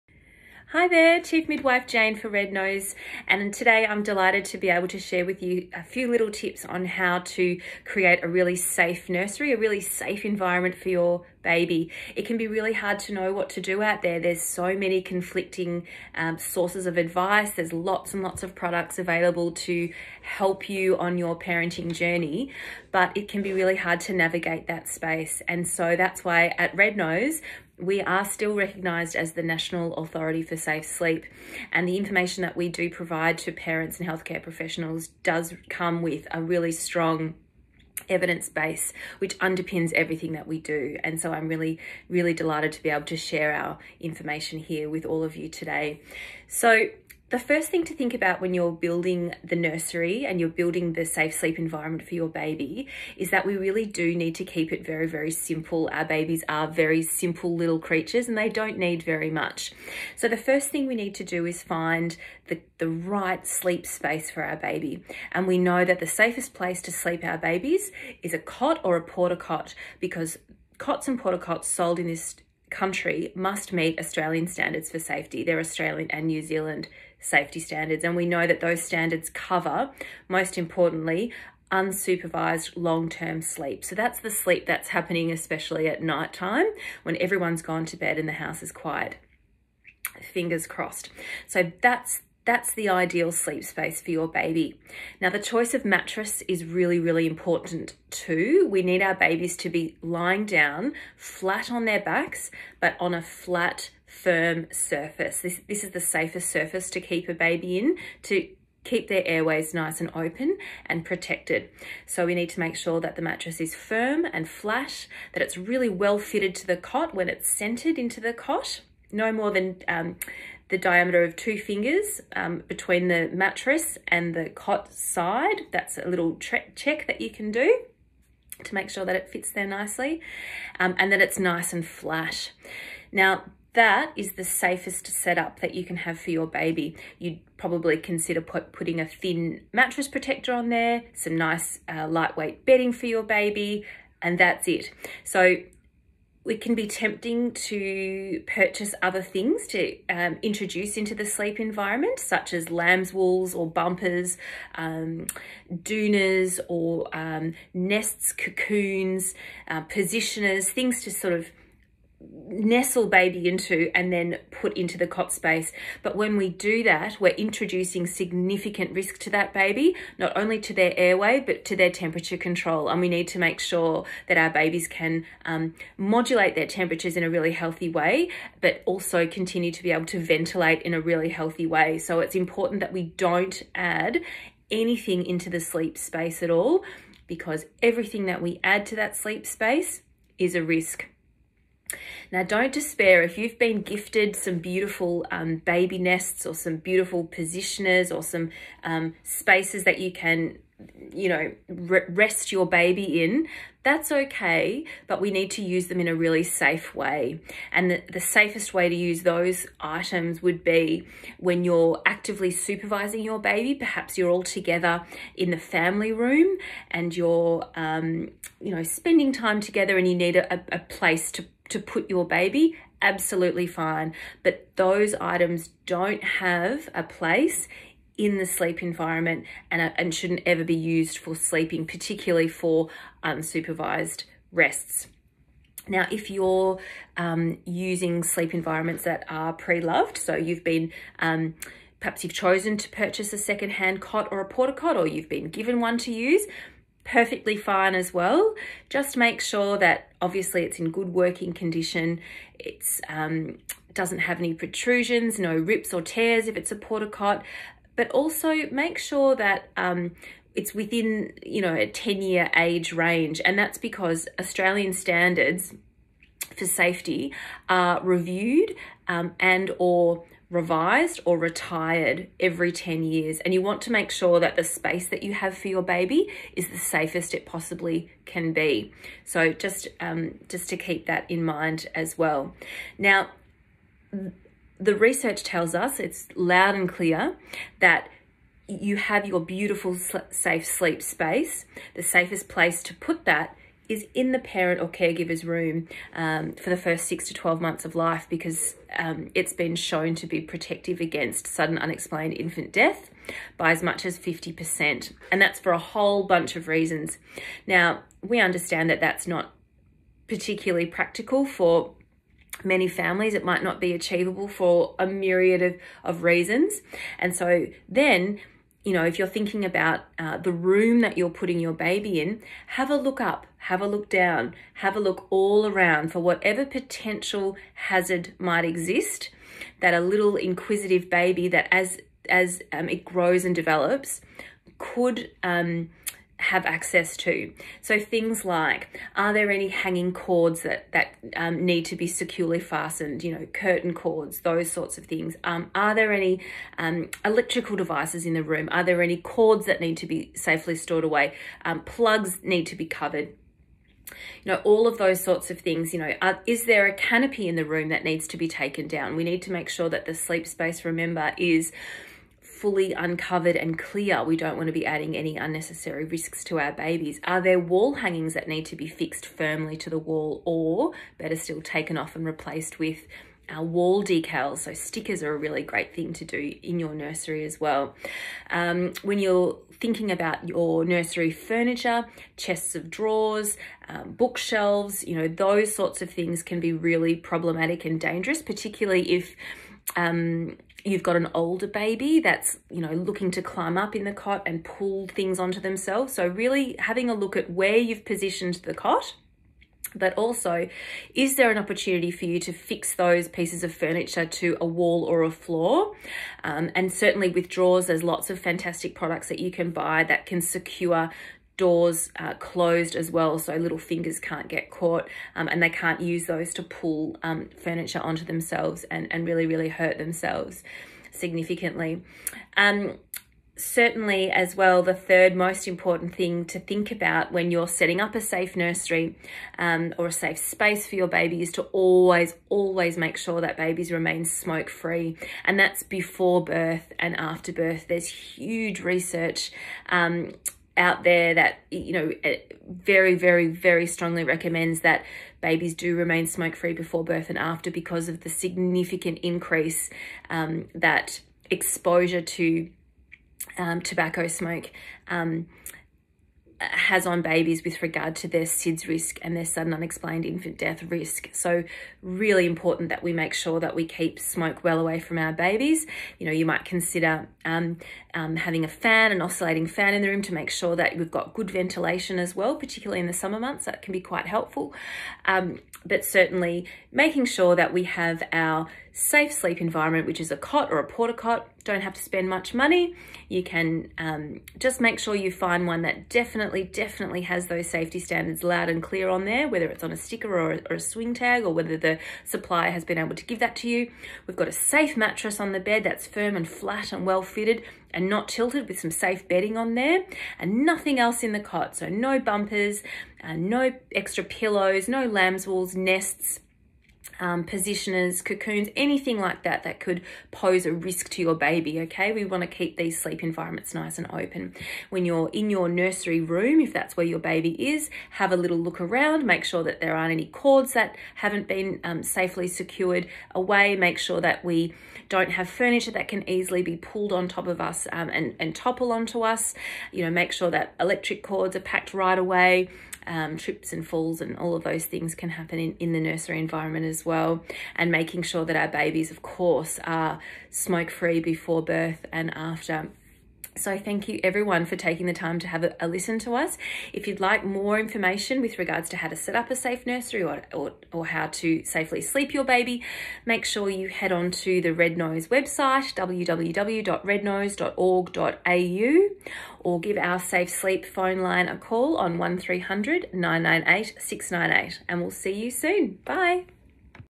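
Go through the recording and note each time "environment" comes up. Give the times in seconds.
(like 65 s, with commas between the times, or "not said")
10 s, 51 s, 151 s, 228 s, 238 s, 479 s, 513 s, 536 s.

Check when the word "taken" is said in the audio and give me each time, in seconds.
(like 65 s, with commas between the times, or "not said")
358 s, 371 s.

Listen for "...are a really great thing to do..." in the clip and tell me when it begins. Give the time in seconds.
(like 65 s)
375 s.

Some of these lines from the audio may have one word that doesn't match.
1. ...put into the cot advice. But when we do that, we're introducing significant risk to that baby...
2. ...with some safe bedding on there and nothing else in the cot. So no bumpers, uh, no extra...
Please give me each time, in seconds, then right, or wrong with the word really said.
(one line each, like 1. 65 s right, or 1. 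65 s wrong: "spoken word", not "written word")
1. 164 s wrong: "space", not "advice"
2. 498 s right.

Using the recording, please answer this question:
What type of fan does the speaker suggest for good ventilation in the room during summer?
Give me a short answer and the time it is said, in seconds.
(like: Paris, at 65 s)
oscillating fan, at 469 s.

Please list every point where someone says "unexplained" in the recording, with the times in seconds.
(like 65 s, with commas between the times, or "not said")
301 s, 459 s.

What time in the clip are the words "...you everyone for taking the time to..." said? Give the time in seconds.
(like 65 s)
544 s.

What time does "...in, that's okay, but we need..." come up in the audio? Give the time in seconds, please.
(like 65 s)
203 s.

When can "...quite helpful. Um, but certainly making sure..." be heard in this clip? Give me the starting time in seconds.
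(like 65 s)
474 s.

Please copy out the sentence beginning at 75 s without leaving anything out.
They're Australian and New Zealand safety standards, and we know that those standards cover, most importantly, unsupervised long-term sleep.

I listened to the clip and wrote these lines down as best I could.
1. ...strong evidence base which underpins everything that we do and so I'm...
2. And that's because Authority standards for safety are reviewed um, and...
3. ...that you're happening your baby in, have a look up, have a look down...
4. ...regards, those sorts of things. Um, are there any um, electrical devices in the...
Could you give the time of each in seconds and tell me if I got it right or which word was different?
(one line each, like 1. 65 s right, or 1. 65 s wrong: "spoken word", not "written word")
1. 36 s right
2. 263 s wrong: "Australian", not "Authority"
3. 321 s wrong: "putting", not "happening"
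4. 343 s wrong: "cords", not "regards".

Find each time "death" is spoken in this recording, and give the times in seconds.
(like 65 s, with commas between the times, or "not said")
302 s, 460 s.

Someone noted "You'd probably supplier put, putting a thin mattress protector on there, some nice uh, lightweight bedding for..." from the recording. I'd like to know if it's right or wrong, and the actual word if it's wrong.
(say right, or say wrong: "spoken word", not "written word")
wrong: "consider", not "supplier".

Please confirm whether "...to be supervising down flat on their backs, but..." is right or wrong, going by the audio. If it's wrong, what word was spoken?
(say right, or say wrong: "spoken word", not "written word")
wrong: "lying", not "supervising".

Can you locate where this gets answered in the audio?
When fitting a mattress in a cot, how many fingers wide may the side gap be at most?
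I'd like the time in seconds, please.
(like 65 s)
121 s.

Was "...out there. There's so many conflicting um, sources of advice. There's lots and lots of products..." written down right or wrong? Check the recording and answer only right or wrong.
right.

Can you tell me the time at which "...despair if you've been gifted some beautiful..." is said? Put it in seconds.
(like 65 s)
192 s.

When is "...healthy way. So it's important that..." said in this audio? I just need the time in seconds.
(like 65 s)
181 s.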